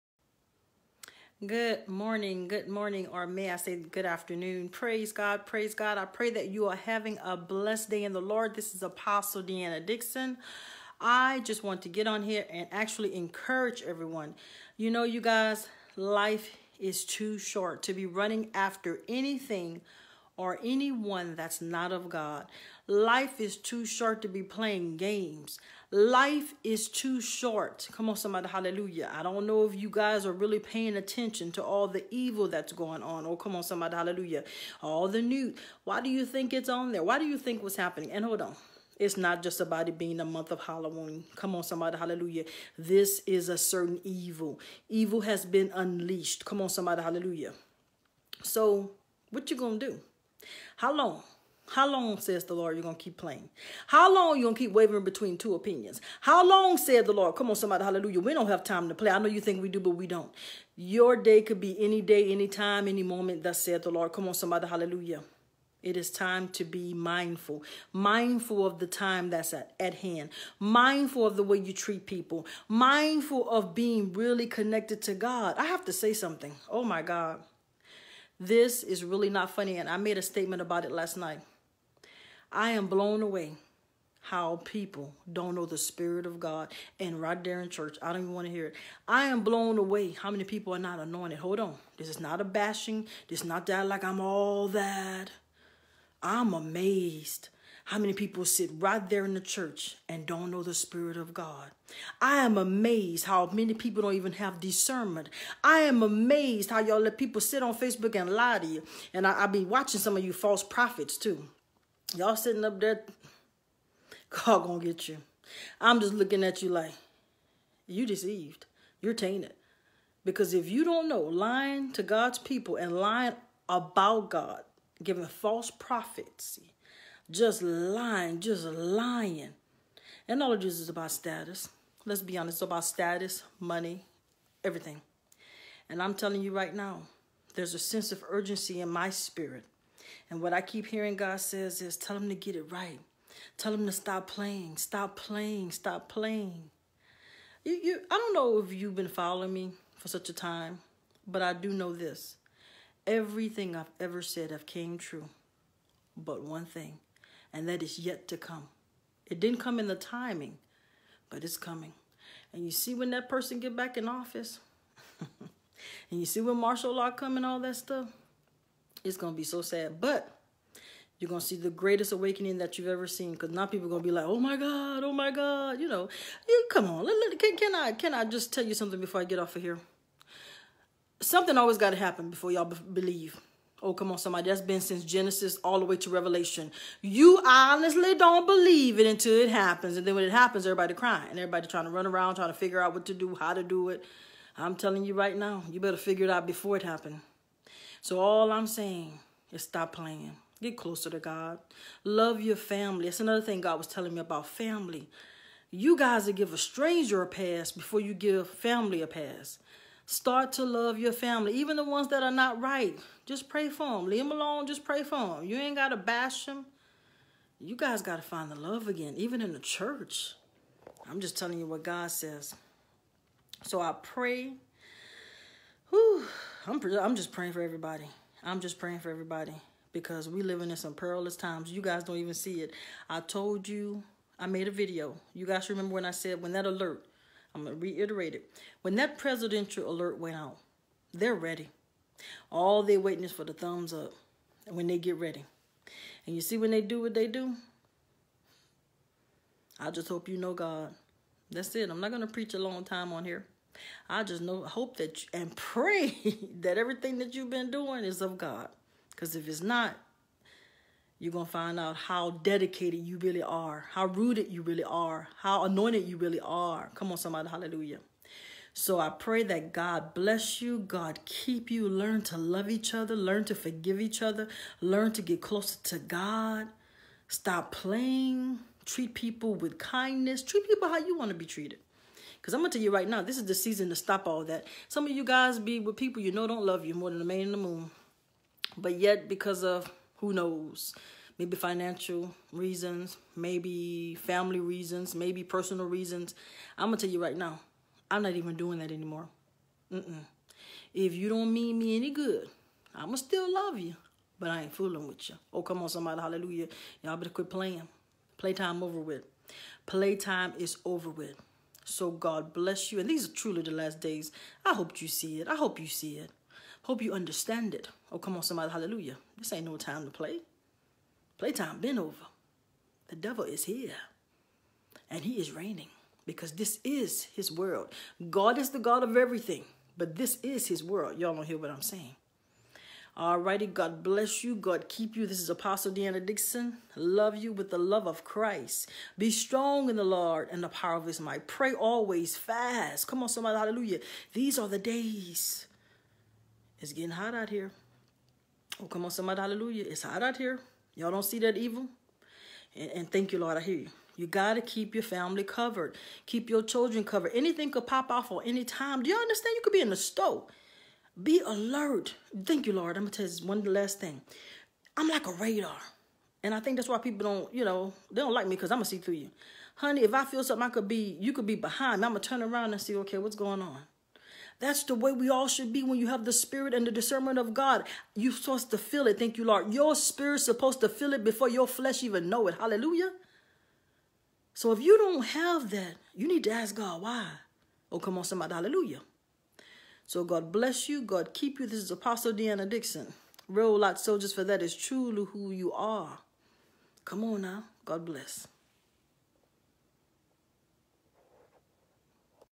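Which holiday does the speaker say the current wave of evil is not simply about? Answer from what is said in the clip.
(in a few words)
Halloween.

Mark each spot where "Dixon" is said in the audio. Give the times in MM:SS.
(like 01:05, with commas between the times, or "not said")
00:09, 05:36, 06:32.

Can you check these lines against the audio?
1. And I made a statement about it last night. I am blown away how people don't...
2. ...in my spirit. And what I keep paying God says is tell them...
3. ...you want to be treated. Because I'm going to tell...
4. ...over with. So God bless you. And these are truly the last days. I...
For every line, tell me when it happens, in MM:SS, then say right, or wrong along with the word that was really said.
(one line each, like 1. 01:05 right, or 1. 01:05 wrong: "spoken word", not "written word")
1. 01:19 right
2. 02:18 wrong: "hearing", not "paying"
3. 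04:40 right
4. 05:10 right.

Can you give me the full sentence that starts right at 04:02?
All they're waiting is for the thumbs up when they get ready.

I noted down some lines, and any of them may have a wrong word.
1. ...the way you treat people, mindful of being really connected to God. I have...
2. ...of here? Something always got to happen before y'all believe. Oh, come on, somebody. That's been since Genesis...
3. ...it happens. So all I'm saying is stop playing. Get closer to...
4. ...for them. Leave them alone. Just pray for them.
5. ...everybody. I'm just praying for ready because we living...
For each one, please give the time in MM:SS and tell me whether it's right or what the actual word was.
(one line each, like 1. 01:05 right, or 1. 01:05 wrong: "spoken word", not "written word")
1. 01:11 right
2. 02:59 right
3. 03:16 right
4. 03:33 right
5. 03:47 wrong: "everybody", not "ready".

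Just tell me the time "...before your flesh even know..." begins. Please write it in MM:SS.
06:21.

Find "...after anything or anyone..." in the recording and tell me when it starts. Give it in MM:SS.
00:18.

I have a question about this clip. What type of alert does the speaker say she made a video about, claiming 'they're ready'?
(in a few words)
presidential alert.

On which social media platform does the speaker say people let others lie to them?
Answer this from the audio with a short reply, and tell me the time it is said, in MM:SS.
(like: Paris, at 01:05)
Facebook, at 01:47.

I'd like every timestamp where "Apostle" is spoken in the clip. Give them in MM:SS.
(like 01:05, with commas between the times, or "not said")
00:08, 05:35, 06:31.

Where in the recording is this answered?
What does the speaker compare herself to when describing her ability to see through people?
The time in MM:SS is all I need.
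06:05.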